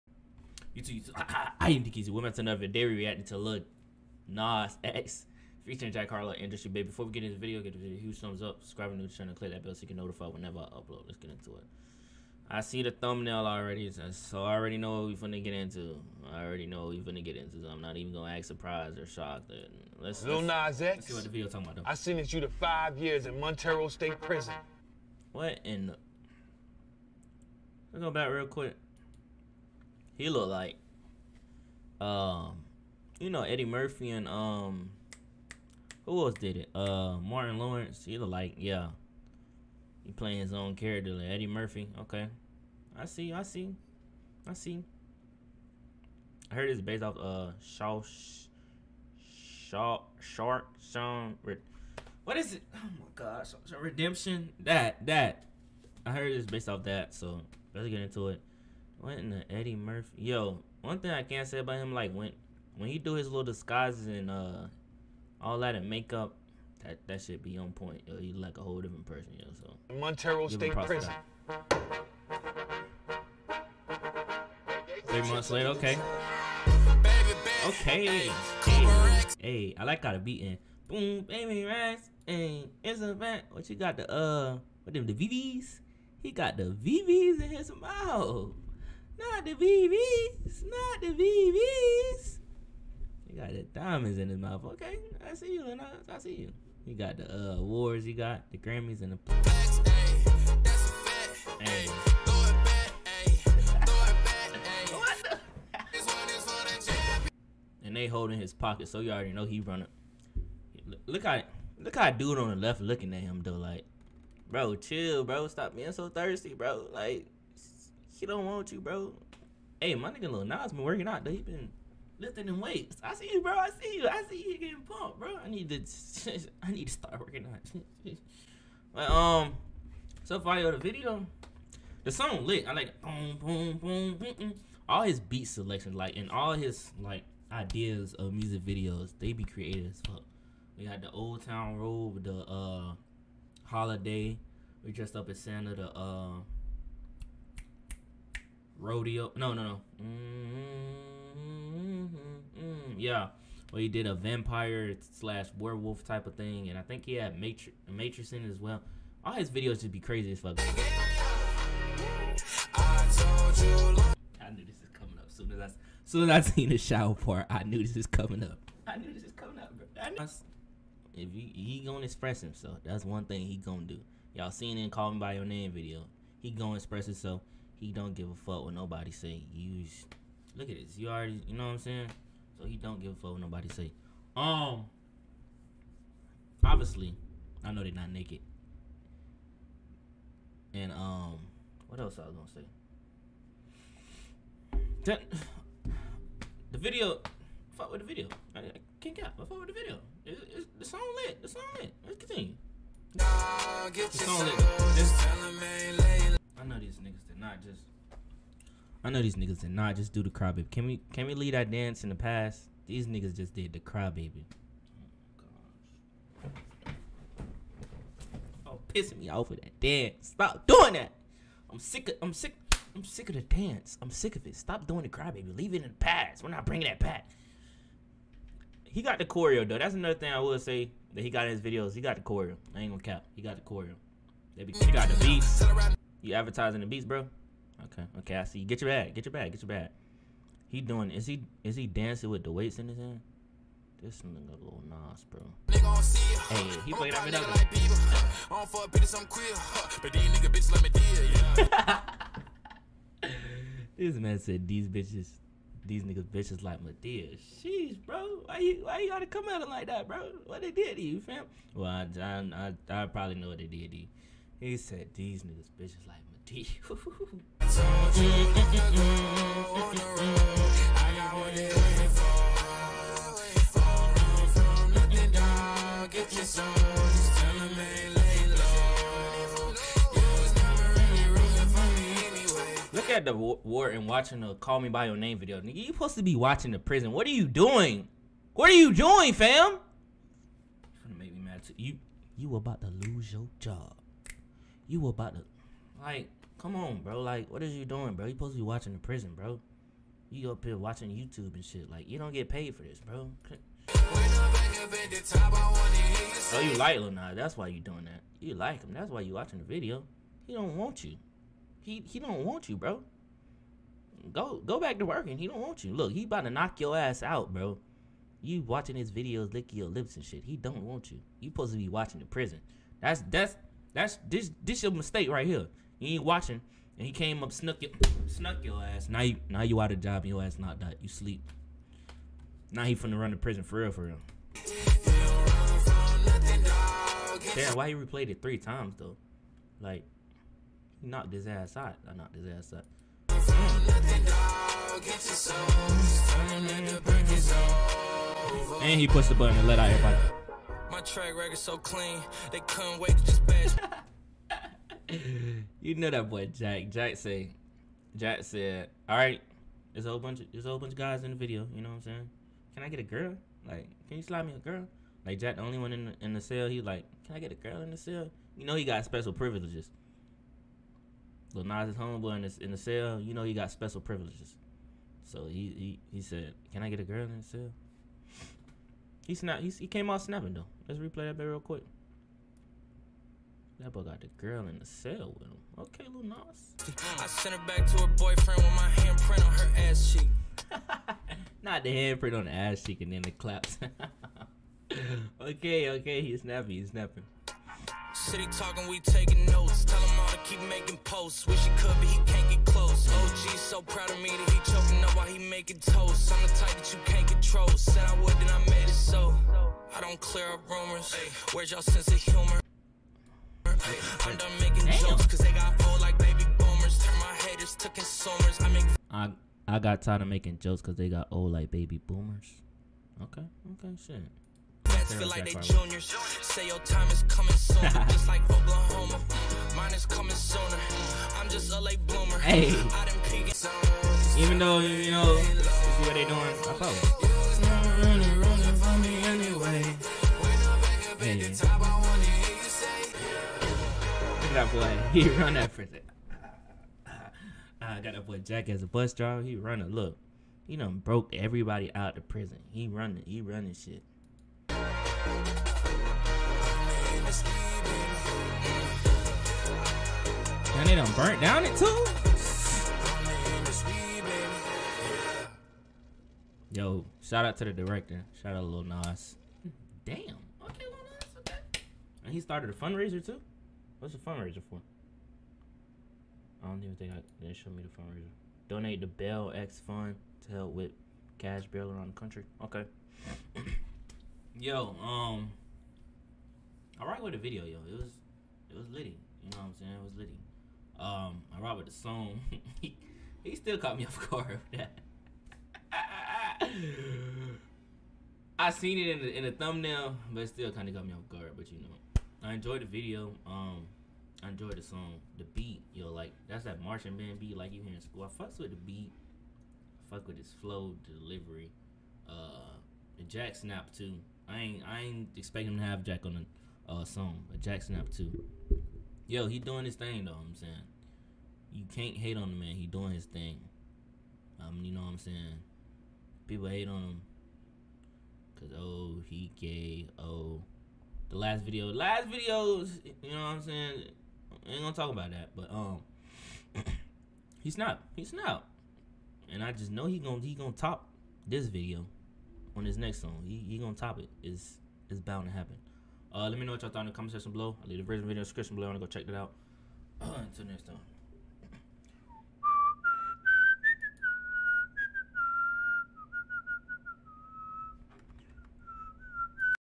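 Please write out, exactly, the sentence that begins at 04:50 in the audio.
You're gonna make me mad too.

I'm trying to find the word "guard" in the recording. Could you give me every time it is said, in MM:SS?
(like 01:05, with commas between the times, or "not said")
08:14, 08:21.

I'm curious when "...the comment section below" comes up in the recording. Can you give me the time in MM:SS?
09:07.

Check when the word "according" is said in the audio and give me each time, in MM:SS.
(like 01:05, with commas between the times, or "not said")
not said.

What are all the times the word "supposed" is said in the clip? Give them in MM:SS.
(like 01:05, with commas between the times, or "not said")
04:45, 04:58, 05:21.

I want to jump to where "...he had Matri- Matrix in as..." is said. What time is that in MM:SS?
02:37.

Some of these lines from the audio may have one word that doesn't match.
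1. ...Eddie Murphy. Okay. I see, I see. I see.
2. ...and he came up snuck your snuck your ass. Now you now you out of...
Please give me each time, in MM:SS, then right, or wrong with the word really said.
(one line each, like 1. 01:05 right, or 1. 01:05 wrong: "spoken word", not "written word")
1. 00:41 right
2. 05:26 right.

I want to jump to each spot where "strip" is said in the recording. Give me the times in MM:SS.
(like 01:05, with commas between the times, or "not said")
not said.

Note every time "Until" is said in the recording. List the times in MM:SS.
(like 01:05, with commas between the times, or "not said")
09:10.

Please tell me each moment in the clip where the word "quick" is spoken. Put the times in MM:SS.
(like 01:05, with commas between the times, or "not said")
00:28, 06:21.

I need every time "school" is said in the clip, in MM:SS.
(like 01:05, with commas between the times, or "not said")
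08:28.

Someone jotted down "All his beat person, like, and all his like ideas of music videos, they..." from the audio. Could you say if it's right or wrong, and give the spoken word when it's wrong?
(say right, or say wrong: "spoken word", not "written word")
wrong: "selection", not "person".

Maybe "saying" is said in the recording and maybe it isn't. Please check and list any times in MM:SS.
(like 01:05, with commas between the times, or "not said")
03:01, 06:02, 08:09, 08:40, 08:45, 08:53.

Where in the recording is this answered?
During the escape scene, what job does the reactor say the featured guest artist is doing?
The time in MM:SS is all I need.
07:28.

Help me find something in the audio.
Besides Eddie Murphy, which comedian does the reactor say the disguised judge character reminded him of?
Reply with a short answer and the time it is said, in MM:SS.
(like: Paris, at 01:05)
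Martin Lawrence, at 00:37.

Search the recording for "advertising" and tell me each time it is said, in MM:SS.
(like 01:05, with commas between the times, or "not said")
03:56.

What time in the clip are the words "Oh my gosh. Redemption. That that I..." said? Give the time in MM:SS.
00:52.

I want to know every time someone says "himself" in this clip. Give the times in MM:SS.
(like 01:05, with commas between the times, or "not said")
02:52, 02:57.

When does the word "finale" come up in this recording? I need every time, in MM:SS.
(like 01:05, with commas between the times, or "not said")
not said.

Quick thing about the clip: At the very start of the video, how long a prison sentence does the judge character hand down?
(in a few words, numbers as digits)
5 years.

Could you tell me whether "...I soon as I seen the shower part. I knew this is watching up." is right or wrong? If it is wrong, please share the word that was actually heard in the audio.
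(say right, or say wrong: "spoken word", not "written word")
wrong: "coming", not "watching".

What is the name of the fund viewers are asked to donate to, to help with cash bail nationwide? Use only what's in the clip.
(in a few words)
Bail X Fund.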